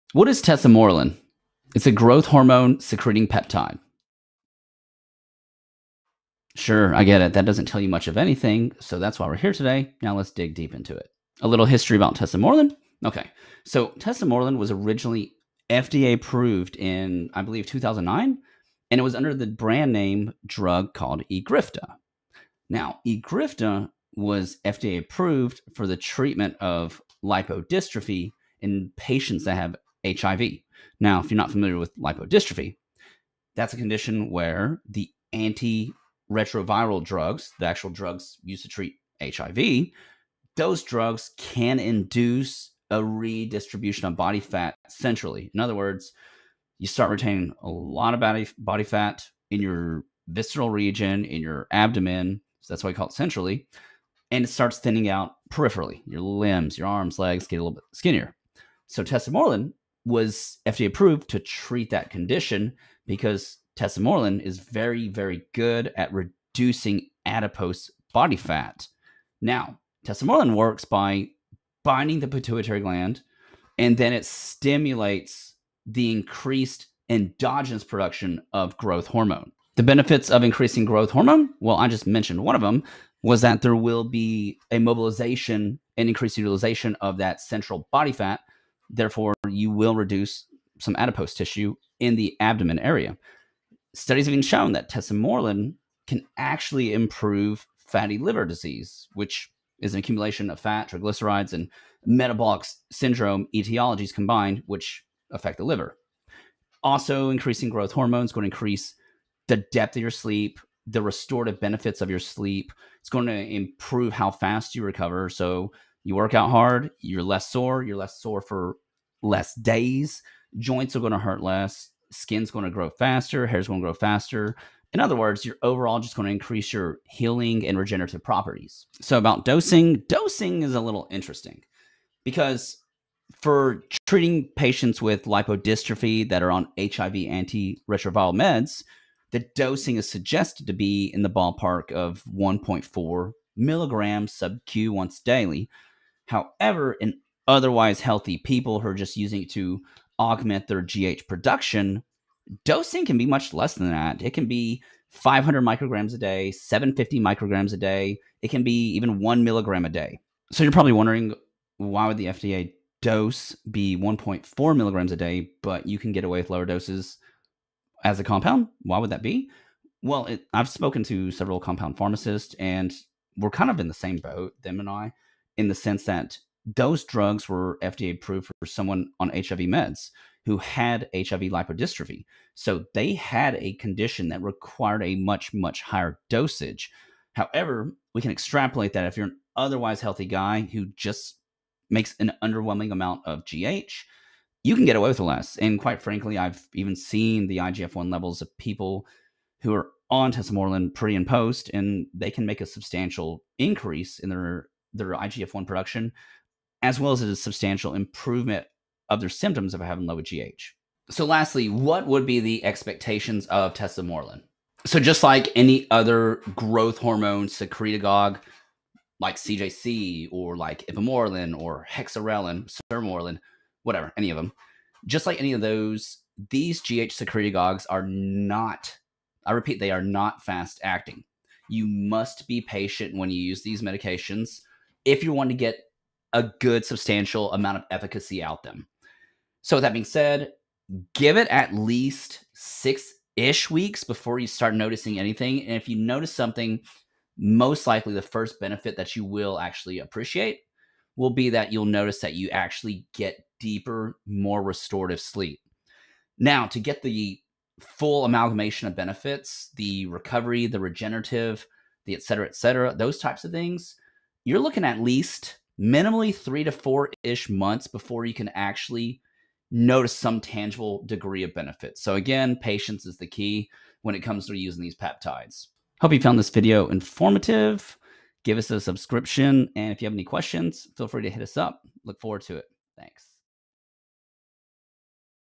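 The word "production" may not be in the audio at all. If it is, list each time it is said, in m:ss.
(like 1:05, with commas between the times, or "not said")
1:17, 2:31, 3:25.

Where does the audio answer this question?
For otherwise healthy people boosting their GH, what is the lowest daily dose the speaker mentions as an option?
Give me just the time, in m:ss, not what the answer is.
2:35.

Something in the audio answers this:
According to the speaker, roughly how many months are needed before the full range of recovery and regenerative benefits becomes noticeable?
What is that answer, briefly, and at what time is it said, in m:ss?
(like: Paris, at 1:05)
3 to 4 months, at 4:26.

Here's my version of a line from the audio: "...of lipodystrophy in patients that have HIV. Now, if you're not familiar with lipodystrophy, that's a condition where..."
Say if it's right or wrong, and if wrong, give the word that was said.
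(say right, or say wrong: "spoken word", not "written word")
right.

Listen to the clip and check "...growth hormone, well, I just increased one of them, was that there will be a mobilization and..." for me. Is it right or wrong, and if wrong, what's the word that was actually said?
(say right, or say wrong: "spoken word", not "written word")
wrong: "mentioned", not "increased".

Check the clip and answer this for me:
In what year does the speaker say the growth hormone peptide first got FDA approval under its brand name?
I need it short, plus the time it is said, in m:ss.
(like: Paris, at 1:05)
2009, at 0:17.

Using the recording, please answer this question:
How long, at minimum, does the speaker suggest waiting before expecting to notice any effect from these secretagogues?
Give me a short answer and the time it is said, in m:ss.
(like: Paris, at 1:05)
6 weeks, at 4:02.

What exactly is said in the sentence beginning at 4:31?
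So, again, patience is the key when it comes to using these peptides.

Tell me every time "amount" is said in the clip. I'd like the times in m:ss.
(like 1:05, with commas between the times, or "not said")
3:12, 3:57.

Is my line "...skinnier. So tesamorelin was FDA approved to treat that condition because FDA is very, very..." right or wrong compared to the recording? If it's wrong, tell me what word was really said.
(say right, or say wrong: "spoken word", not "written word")
wrong: "Tesamorelin", not "FDA".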